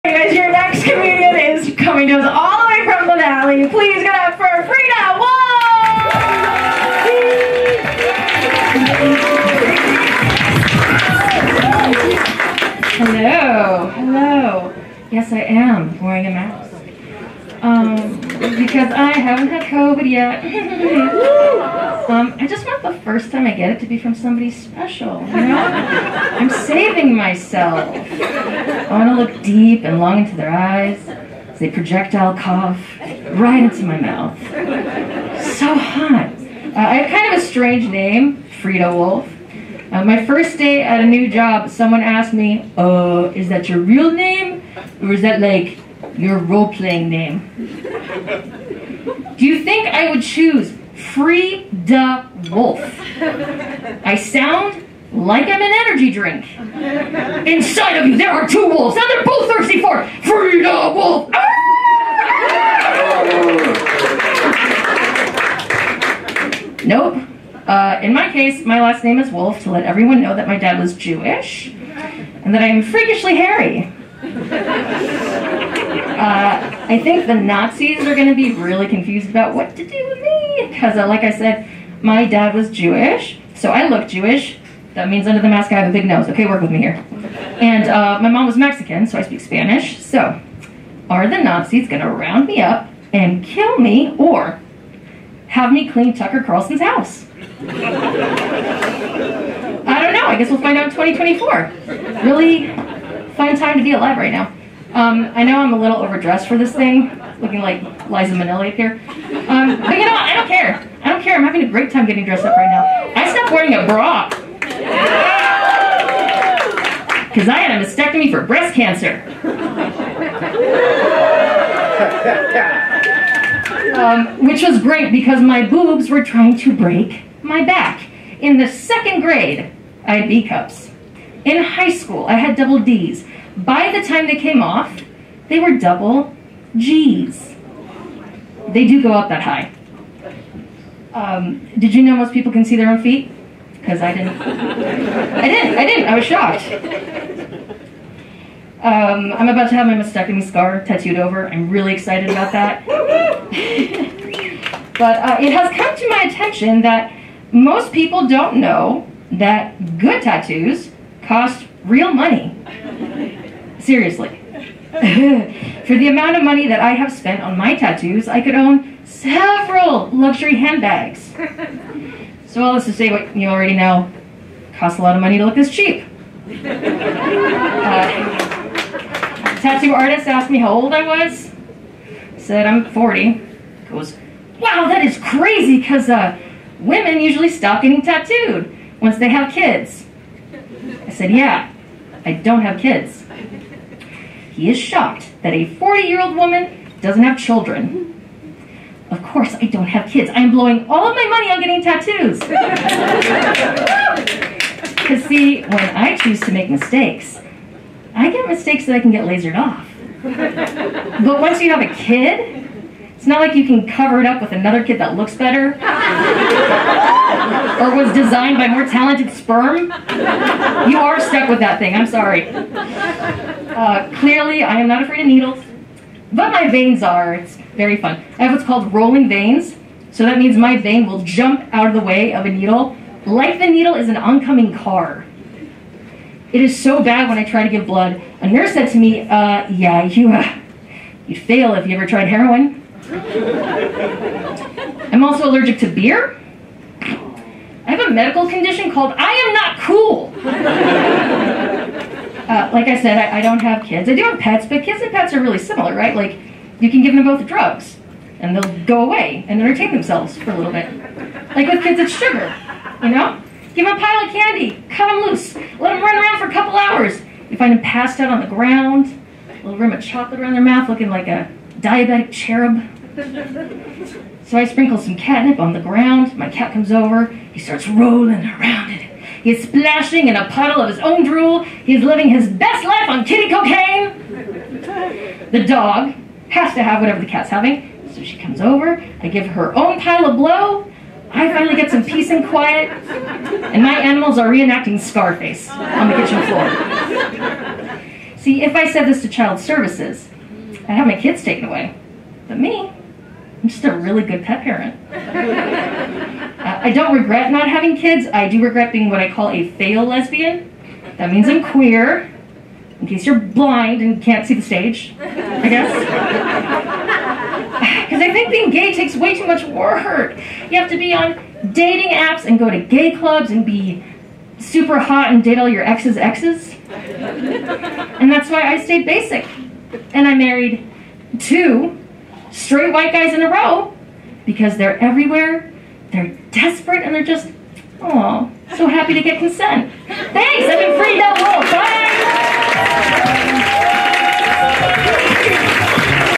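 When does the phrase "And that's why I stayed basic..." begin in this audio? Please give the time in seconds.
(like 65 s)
326 s.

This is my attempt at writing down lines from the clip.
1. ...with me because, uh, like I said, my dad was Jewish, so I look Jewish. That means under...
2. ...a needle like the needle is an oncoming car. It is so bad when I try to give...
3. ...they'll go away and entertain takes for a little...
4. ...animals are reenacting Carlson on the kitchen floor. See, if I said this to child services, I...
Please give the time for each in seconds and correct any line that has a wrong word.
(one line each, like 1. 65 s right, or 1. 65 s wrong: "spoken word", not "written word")
1. 80 s right
2. 232 s right
3. 258 s wrong: "themselves", not "takes"
4. 293 s wrong: "Scarface", not "Carlson".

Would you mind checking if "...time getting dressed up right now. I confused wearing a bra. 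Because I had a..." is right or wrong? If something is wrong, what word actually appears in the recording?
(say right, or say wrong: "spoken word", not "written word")
wrong: "stopped", not "confused".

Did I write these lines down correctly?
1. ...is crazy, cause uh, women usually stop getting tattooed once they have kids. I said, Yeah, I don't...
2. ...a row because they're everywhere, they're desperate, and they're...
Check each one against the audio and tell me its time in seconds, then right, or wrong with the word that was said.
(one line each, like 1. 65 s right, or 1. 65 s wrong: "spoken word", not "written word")
1. 185 s right
2. 333 s right.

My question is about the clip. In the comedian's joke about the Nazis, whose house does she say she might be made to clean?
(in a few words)
Tucker Carlson.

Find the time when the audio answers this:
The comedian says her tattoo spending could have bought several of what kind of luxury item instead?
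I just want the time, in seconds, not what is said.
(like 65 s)
170 s.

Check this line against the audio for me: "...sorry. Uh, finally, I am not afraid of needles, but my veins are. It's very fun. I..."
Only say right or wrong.
wrong.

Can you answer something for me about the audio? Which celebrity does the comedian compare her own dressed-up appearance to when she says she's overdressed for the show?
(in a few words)
Liza Minnelli.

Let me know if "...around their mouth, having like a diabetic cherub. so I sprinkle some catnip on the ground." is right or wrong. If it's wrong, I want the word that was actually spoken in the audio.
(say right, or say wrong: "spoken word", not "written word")
wrong: "looking", not "having".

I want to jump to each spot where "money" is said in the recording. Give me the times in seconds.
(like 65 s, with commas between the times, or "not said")
162 s, 166 s, 175 s, 201 s.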